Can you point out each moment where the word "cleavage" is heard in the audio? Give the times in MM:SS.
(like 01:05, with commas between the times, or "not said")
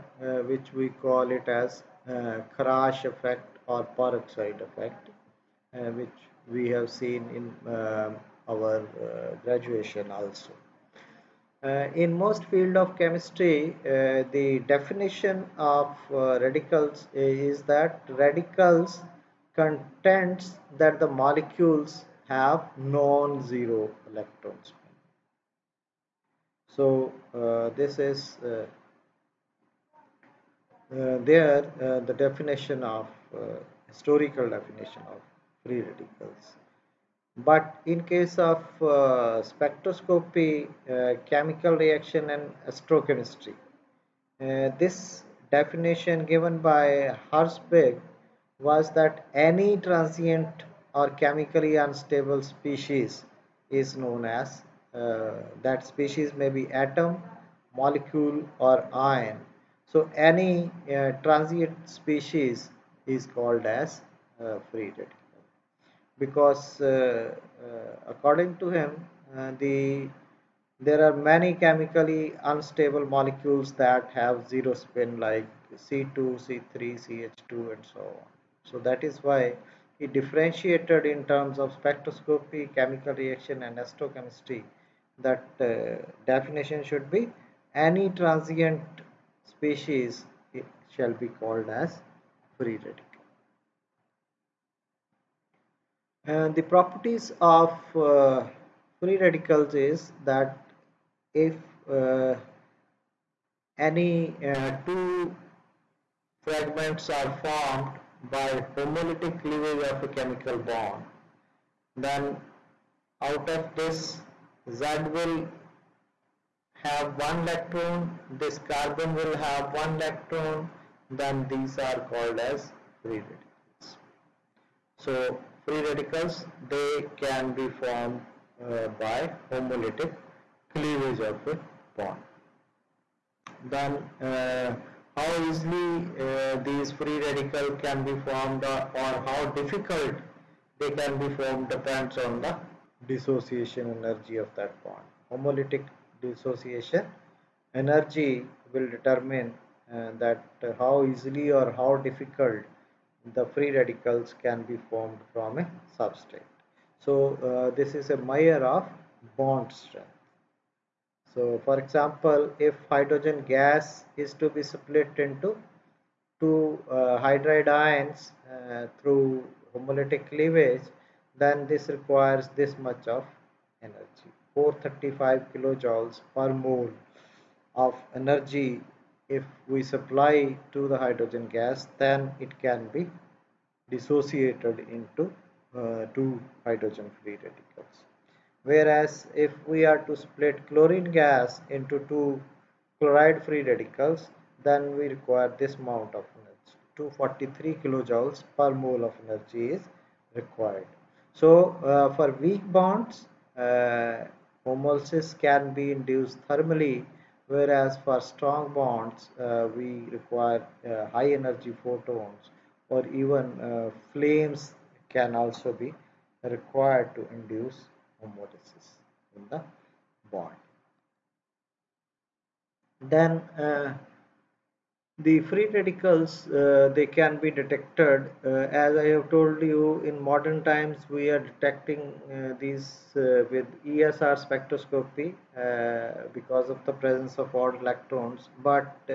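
01:49, 02:10, 02:50.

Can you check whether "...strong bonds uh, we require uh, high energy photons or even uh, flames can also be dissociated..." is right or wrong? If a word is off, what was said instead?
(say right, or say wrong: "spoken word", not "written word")
wrong: "required", not "dissociated".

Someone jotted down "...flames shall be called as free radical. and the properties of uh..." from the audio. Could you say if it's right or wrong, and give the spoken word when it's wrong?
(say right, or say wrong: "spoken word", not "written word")
wrong: "species", not "flames".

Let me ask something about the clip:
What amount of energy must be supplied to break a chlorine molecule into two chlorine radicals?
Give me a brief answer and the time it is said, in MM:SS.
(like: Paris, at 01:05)
243 kJ/mol, at 03:17.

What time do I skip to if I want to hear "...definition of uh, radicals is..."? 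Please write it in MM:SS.
00:14.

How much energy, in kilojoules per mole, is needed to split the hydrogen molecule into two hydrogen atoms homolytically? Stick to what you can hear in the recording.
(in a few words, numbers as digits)
435 kJ/mol.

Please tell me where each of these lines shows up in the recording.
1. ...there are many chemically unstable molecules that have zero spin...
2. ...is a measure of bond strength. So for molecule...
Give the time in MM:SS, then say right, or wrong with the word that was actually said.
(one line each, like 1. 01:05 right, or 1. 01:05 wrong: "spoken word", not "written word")
1. 01:10 right
2. 02:37 wrong: "example", not "molecule".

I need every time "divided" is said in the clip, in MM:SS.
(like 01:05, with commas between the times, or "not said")
not said.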